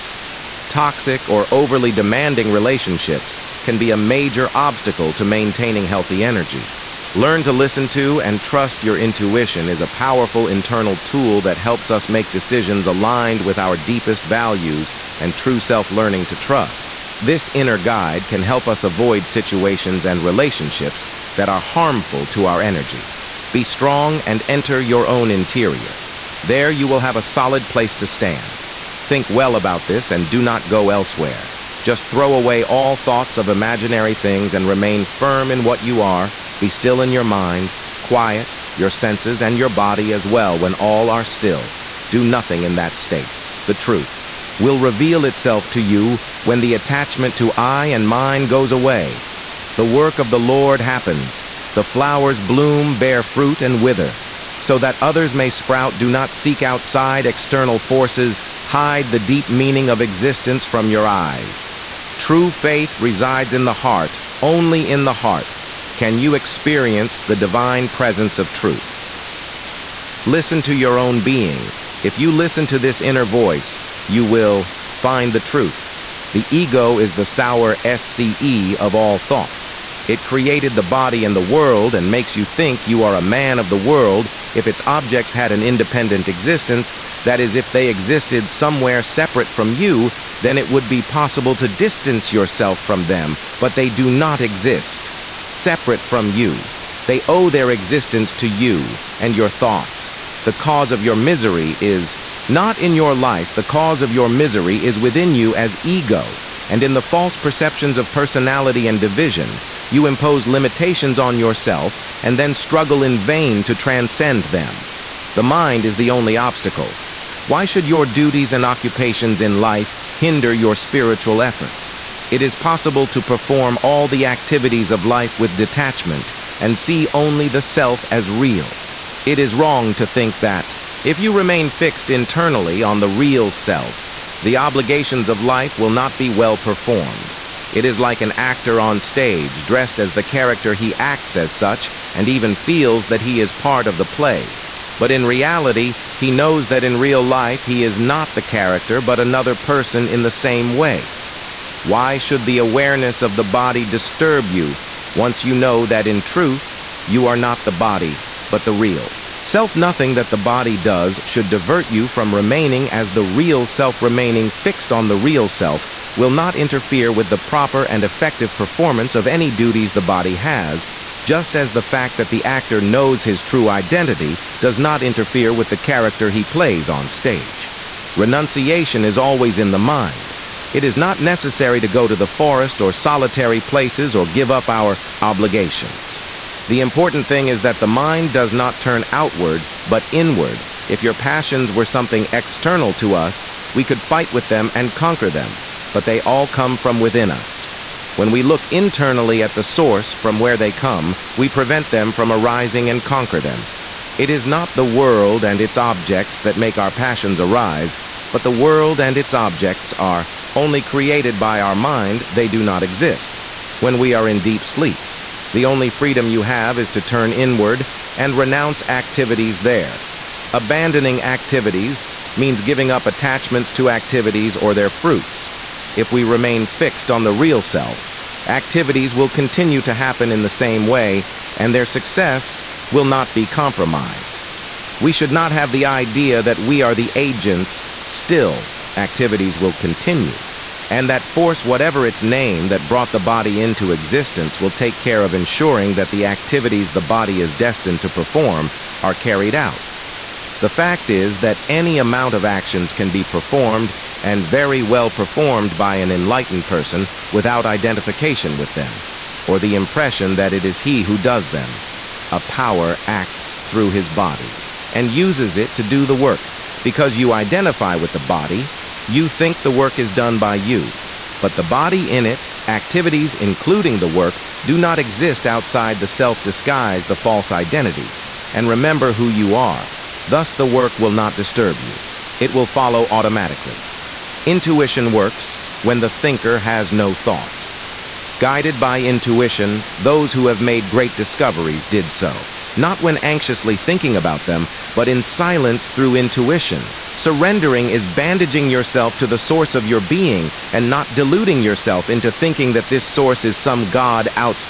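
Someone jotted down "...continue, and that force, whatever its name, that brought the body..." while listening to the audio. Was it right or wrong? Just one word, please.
right.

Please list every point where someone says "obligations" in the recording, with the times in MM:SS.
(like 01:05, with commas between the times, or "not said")
02:14, 03:05.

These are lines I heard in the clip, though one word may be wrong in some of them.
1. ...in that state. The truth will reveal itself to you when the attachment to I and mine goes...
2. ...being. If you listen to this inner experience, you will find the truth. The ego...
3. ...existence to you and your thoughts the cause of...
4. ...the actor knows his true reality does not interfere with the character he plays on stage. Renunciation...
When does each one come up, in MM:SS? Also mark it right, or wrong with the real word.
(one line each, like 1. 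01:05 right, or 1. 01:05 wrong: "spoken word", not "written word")
1. 00:42 right
2. 01:11 wrong: "voice", not "experience"
3. 01:37 right
4. 02:52 wrong: "identity", not "reality".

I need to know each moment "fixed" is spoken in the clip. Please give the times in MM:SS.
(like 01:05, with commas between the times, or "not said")
02:11, 02:44, 03:46.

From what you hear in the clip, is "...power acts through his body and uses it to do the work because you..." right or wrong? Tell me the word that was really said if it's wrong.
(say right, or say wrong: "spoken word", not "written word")
right.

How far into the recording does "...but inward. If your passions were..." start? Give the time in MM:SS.
03:09.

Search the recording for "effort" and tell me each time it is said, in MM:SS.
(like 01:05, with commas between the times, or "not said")
02:01.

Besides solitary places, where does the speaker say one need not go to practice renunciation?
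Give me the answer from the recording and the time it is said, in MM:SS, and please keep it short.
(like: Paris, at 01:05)
The forest, at 03:02.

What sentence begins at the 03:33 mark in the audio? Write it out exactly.
When we are in deep sleep, the only freedom you have is to turn inward and renounce activities there.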